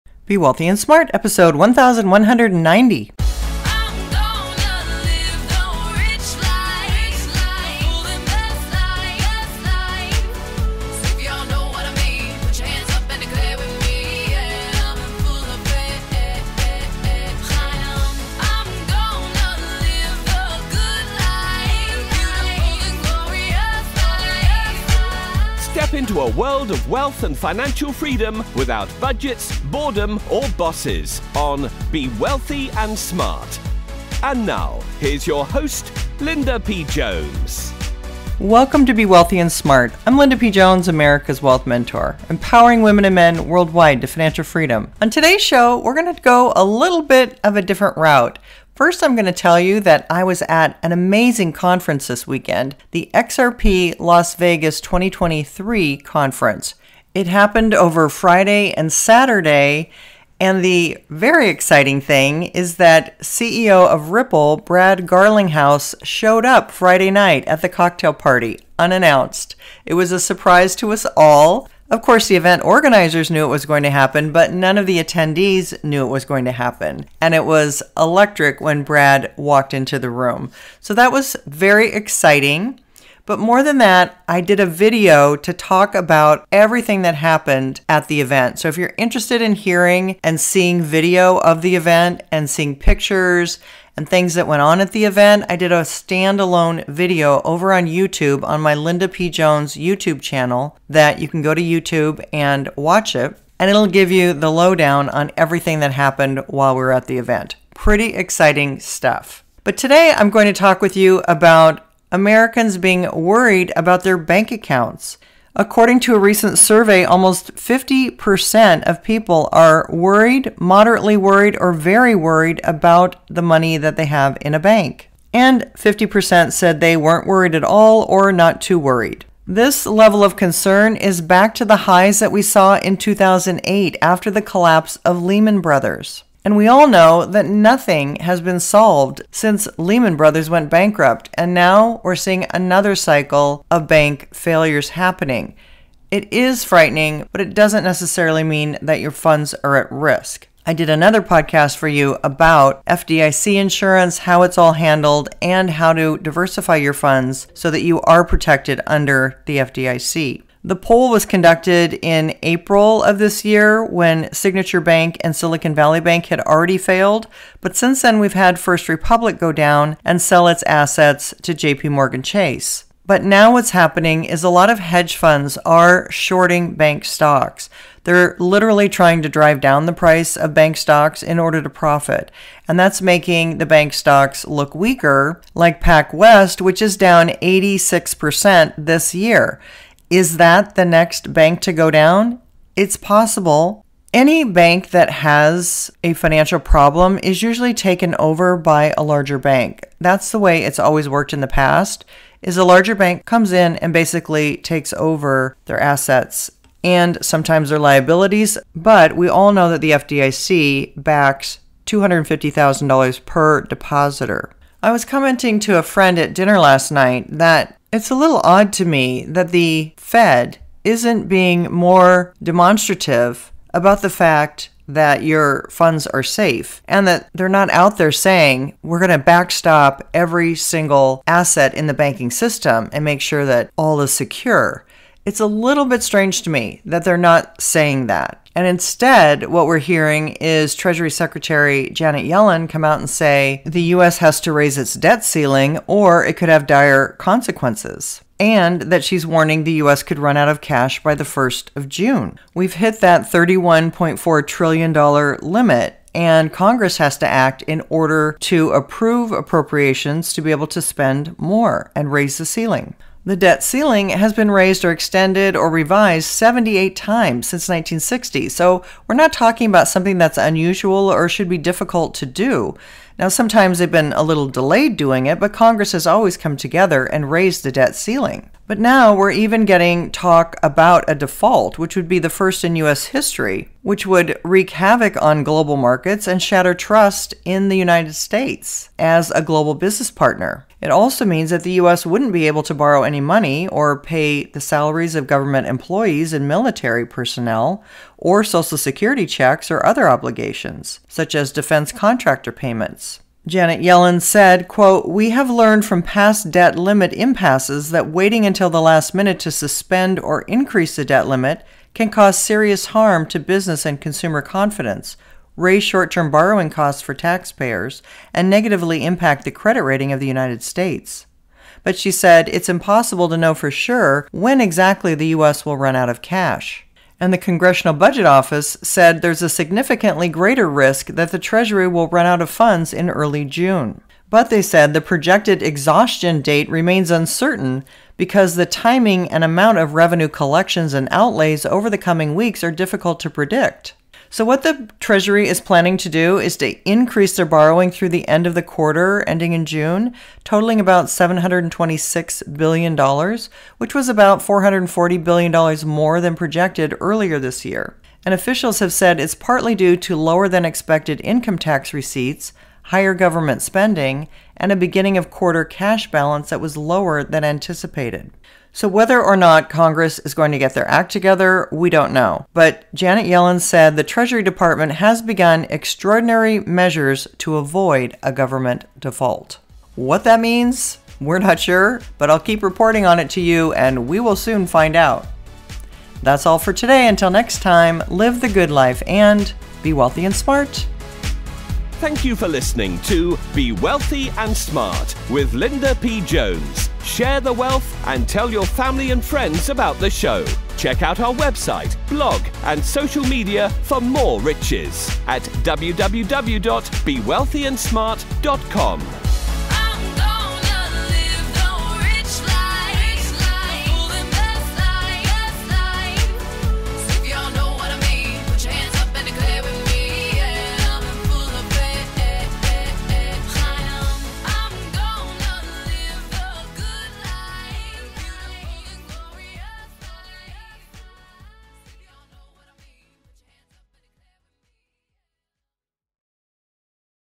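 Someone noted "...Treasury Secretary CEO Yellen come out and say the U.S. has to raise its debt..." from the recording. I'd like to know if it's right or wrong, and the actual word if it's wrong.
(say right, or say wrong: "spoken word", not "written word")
wrong: "Janet", not "CEO".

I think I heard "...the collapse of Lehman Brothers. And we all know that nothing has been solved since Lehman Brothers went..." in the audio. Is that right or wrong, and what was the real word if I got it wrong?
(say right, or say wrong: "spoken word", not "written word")
right.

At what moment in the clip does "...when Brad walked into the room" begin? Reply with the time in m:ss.
1:18.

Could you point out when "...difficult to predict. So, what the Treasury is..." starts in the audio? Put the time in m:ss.
5:42.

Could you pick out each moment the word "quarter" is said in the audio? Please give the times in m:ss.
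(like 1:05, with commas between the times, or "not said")
5:48, 6:05.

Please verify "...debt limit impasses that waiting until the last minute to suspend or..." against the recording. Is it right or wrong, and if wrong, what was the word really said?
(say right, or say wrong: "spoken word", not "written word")
right.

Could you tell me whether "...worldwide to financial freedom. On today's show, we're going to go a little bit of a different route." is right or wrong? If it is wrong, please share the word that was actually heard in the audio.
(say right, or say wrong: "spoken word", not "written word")
right.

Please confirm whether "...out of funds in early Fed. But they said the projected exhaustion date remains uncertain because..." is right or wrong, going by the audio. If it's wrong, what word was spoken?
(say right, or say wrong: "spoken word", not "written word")
wrong: "June", not "Fed".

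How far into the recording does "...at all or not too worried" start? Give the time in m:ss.
2:07.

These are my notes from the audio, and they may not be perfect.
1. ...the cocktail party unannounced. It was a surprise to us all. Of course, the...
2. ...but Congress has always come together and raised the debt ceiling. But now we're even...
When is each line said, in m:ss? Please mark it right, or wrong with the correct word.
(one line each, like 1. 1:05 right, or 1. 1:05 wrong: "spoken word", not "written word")
1. 1:07 right
2. 4:35 right.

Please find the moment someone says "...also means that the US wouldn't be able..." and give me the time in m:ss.
4:50.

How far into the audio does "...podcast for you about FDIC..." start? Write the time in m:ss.
2:31.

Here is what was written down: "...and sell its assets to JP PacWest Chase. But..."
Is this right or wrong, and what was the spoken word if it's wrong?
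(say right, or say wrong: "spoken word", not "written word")
wrong: "Morgan", not "PacWest".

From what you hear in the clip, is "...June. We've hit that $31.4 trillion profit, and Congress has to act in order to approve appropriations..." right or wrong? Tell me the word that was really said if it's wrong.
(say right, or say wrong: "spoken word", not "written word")
wrong: "limit", not "profit".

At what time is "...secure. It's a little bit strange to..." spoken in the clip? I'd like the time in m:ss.
3:54.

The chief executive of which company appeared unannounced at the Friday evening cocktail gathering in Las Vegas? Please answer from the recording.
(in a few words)
Ripple.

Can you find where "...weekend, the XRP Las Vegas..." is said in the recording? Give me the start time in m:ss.
0:52.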